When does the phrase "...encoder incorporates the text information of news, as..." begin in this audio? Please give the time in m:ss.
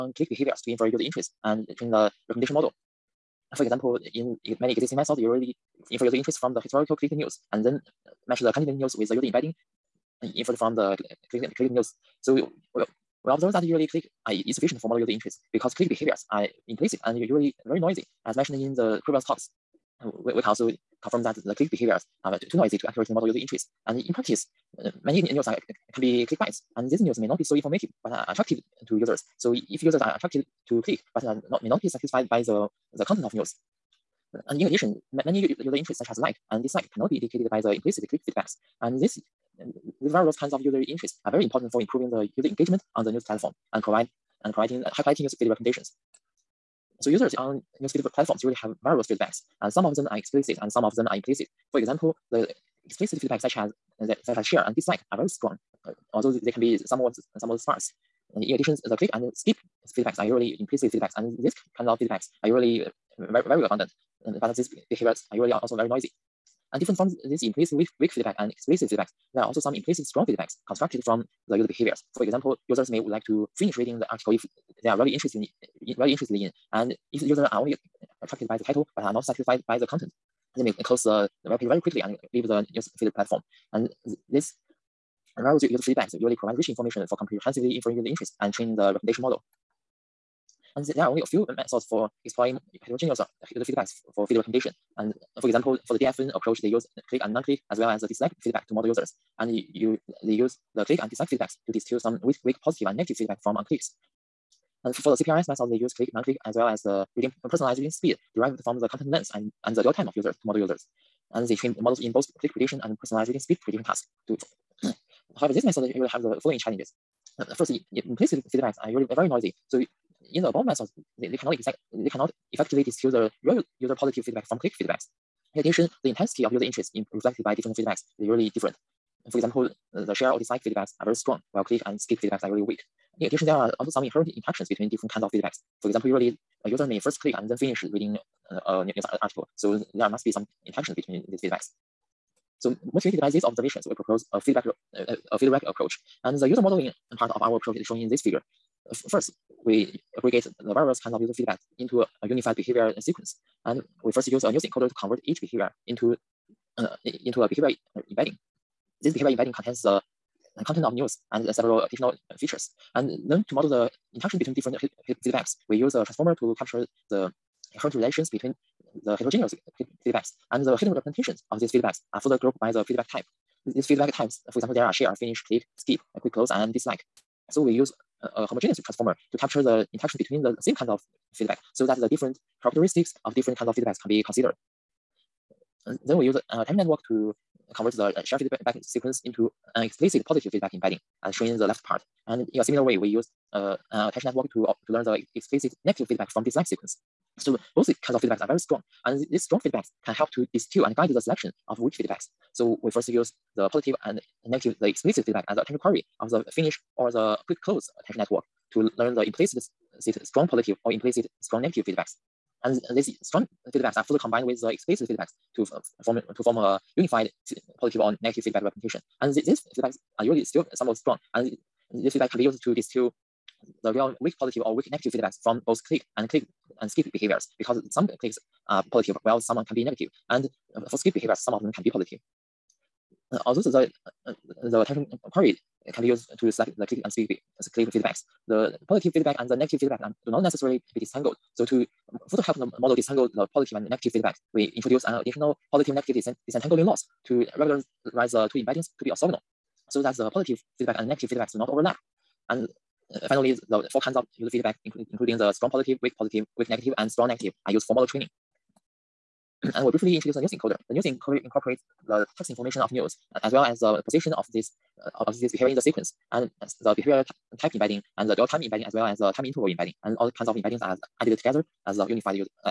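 4:21.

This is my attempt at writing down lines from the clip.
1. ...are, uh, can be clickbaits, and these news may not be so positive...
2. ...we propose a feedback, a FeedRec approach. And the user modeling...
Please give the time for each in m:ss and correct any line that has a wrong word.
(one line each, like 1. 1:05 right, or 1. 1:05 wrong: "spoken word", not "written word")
1. 0:25 wrong: "informative", not "positive"
2. 2:23 right.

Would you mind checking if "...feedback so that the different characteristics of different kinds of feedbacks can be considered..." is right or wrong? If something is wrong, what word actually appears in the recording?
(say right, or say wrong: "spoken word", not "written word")
right.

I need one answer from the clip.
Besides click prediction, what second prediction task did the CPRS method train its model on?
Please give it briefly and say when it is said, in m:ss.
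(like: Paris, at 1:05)
personalized reading speed prediction, at 1:53.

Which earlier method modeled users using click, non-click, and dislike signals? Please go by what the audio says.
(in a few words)
DFN.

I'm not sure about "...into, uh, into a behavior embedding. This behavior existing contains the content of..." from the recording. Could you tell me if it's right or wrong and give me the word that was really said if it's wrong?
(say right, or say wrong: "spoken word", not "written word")
wrong: "embedding", not "existing".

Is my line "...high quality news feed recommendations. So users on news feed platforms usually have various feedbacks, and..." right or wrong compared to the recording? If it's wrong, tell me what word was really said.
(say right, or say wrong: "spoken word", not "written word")
right.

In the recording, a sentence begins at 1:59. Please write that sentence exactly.
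So in the above methods, they, they cannot exact, they cannot effectively distill the real user positive feedback from click feedbacks.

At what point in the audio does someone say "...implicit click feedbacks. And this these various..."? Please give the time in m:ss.
0:37.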